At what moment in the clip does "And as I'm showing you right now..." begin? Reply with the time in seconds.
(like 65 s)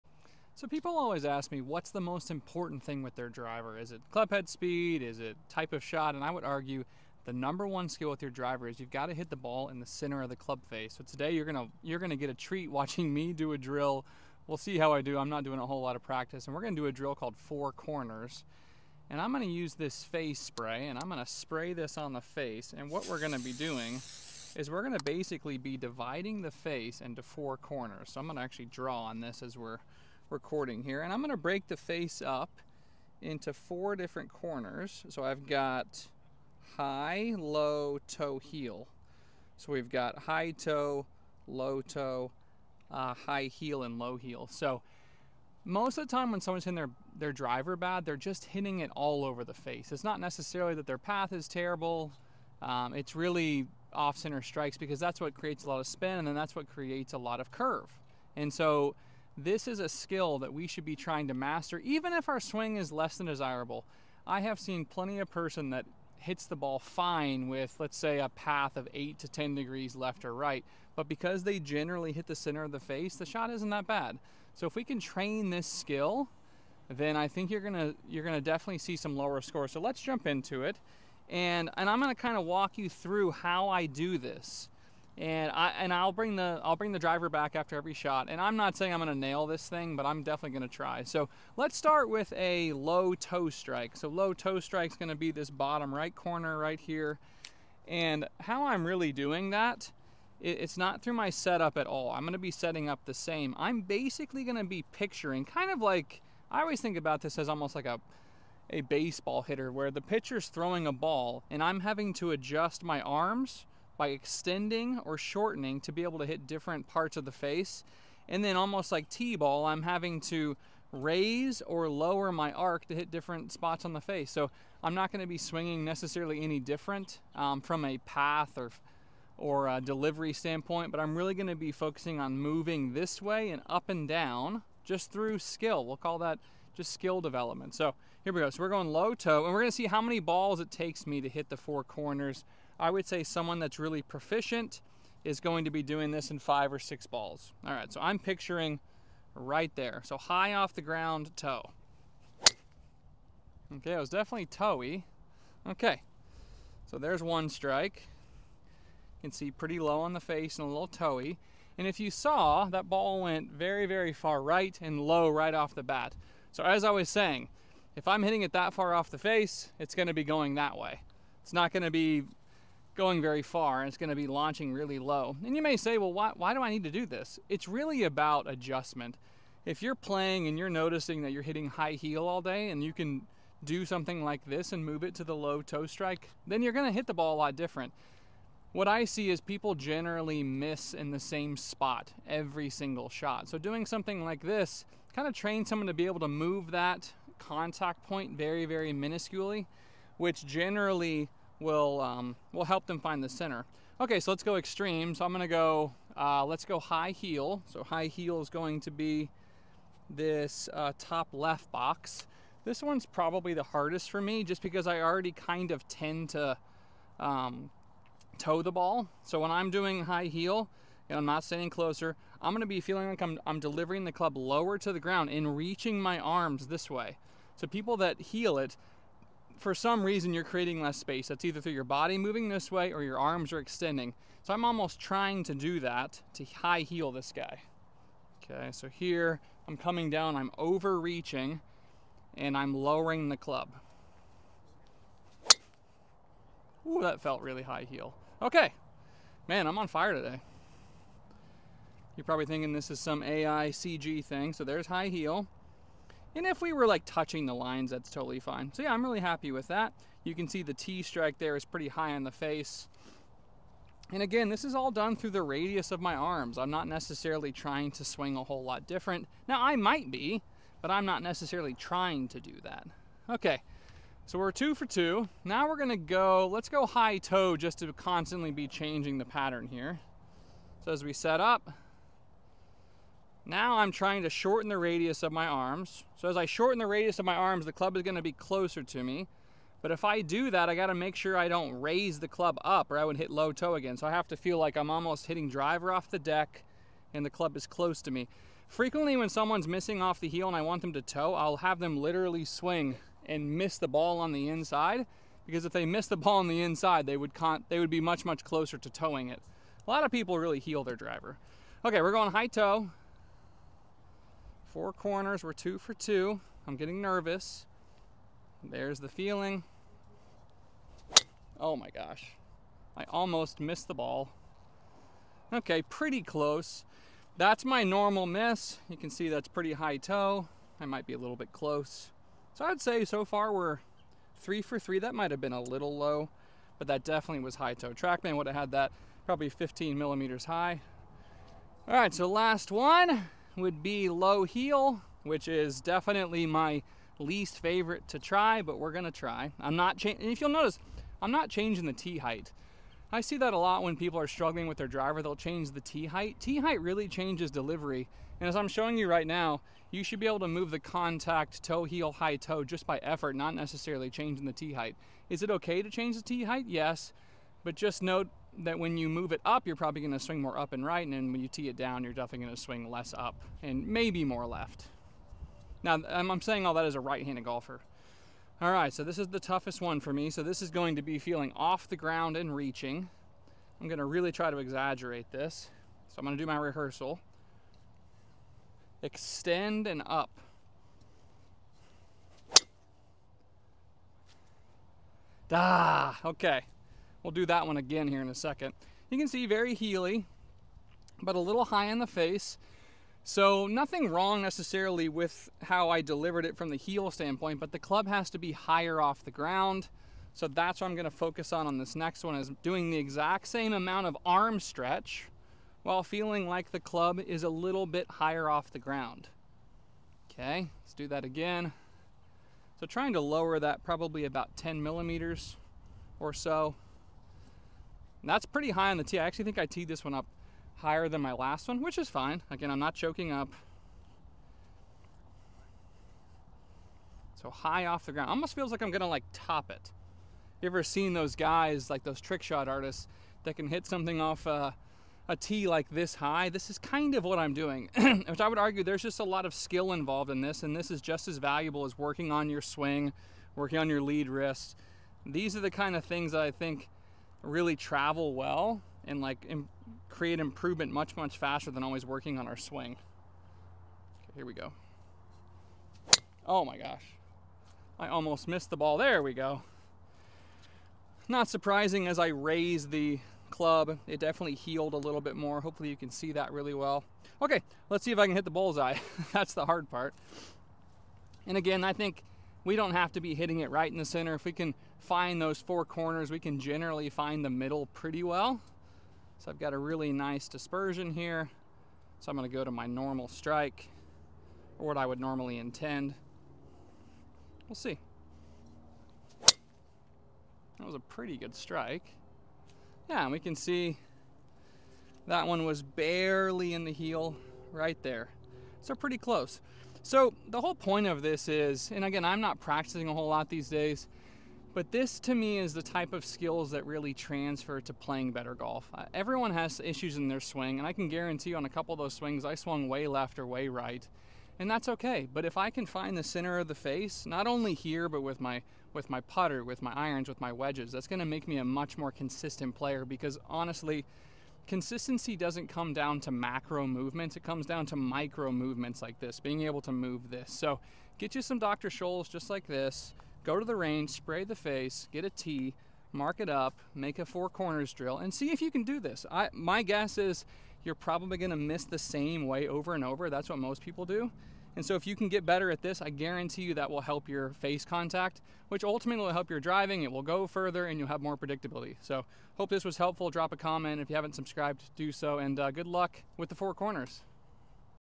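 358 s.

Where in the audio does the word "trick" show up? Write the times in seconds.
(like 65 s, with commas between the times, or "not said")
442 s.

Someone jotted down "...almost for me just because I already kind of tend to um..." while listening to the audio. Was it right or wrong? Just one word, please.
wrong.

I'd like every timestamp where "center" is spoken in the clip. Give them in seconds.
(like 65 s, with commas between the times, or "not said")
9 s, 53 s, 72 s, 203 s, 484 s, 526 s.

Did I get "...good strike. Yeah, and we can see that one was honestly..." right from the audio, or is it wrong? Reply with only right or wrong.
wrong.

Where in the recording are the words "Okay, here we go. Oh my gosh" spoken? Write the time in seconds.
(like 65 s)
462 s.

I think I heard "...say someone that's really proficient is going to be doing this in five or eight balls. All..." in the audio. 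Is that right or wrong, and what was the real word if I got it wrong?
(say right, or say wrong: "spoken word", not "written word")
wrong: "six", not "eight".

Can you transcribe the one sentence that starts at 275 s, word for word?
Now we're gonna go, let's go high toe just to constantly be changing the pattern here.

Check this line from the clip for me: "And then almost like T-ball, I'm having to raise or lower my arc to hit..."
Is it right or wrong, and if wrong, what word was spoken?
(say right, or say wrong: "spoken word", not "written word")
right.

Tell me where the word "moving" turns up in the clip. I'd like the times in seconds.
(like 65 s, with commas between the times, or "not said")
132 s, 232 s.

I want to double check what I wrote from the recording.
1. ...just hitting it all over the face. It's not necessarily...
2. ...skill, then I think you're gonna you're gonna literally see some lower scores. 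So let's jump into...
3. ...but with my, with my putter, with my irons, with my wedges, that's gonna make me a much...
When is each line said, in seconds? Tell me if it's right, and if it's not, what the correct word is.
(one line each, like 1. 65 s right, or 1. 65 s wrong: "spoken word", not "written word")
1. 48 s right
2. 75 s wrong: "definitely", not "literally"
3. 528 s right.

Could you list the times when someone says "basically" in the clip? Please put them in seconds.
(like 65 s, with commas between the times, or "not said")
25 s, 103 s.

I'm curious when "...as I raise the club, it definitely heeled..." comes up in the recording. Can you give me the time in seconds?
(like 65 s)
472 s.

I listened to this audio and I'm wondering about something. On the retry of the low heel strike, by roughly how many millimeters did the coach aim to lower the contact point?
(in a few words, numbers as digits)
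10.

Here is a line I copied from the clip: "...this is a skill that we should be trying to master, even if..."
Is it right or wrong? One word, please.
right.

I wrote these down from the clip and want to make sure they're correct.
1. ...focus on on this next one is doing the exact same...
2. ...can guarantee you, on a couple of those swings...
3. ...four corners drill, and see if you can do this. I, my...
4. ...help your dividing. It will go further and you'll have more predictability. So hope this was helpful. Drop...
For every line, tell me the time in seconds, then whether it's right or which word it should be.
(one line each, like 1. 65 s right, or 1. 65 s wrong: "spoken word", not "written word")
1. 411 s right
2. 520 s right
3. 547 s right
4. 559 s wrong: "driving", not "dividing".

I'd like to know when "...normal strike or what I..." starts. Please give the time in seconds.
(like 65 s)
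492 s.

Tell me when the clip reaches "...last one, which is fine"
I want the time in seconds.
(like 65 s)
431 s.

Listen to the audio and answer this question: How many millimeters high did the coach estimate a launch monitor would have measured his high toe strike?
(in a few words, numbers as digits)
15.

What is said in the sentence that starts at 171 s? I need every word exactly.
It's not gonna be going very far and it's gonna be launching really low.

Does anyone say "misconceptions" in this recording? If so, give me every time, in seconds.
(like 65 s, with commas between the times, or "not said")
not said.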